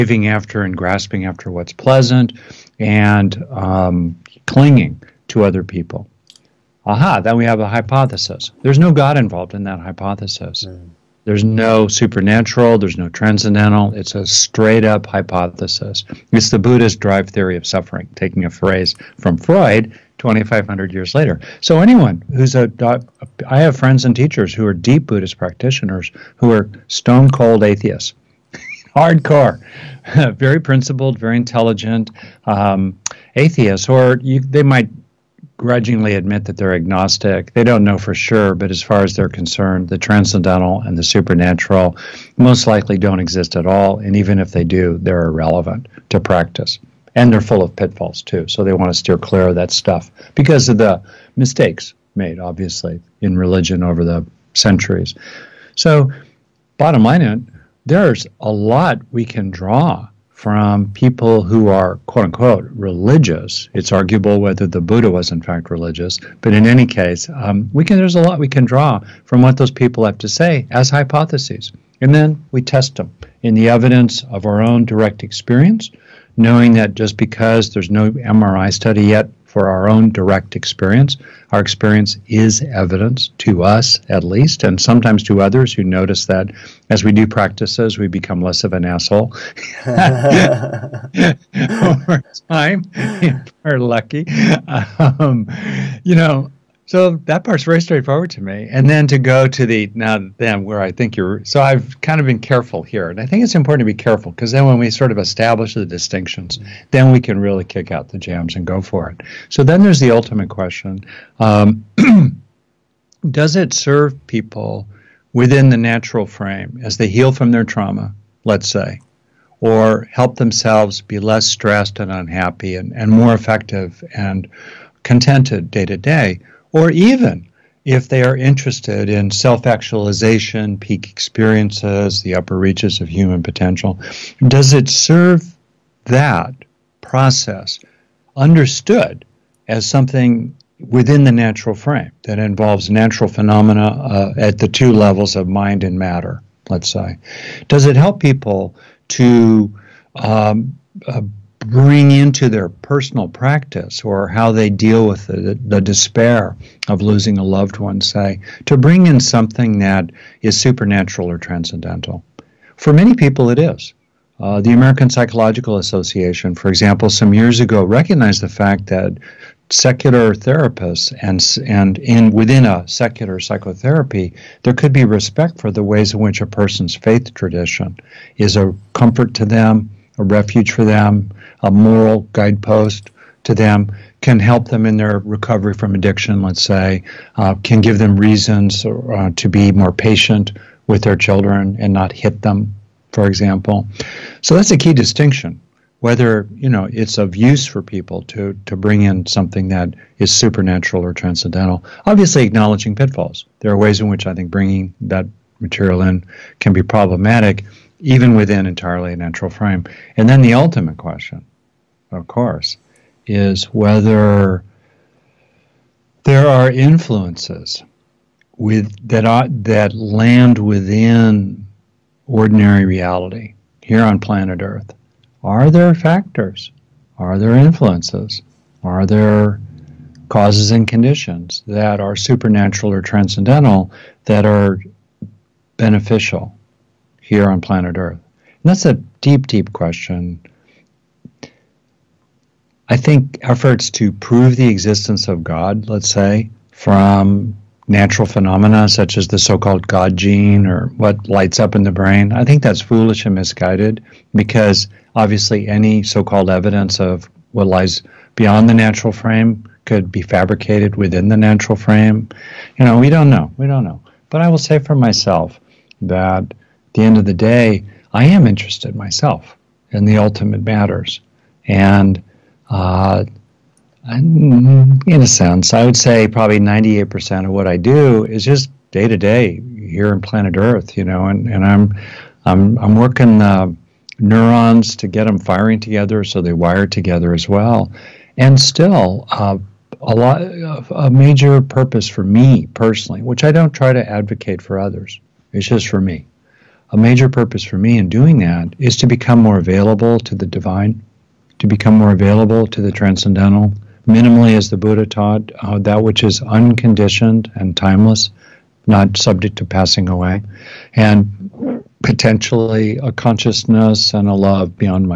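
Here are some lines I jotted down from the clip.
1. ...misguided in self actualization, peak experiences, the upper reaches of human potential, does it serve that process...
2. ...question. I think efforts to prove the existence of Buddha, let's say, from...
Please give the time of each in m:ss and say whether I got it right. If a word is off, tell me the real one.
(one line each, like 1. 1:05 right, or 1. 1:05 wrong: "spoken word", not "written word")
1. 2:08 wrong: "interested", not "misguided"
2. 3:59 wrong: "God", not "Buddha".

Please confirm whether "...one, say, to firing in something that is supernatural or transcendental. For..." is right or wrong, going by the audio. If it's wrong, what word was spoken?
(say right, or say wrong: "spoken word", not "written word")
wrong: "bring", not "firing".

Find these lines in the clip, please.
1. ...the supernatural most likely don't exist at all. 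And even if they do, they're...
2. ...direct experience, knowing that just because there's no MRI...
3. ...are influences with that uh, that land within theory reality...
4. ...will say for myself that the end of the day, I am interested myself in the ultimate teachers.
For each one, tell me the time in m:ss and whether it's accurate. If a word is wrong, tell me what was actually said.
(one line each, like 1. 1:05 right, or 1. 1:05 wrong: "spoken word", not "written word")
1. 0:40 right
2. 1:14 right
3. 3:36 wrong: "ordinary", not "theory"
4. 4:24 wrong: "matters", not "teachers".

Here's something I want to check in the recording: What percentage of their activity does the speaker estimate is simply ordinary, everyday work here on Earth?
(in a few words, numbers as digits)
98%.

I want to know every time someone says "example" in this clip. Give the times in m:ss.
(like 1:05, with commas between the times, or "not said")
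2:46, 3:13.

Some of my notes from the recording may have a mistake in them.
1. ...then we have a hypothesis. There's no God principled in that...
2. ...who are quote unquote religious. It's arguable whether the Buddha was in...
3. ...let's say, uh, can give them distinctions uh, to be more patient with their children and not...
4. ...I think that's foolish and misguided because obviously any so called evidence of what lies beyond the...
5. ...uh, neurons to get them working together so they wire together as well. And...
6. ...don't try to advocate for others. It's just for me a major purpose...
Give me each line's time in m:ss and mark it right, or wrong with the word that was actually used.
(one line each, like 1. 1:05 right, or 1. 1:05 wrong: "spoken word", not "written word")
1. 0:07 wrong: "involved", not "principled"
2. 1:01 right
3. 3:06 wrong: "reasons", not "distinctions"
4. 4:12 right
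5. 4:43 wrong: "firing", not "working"
6. 4:53 right.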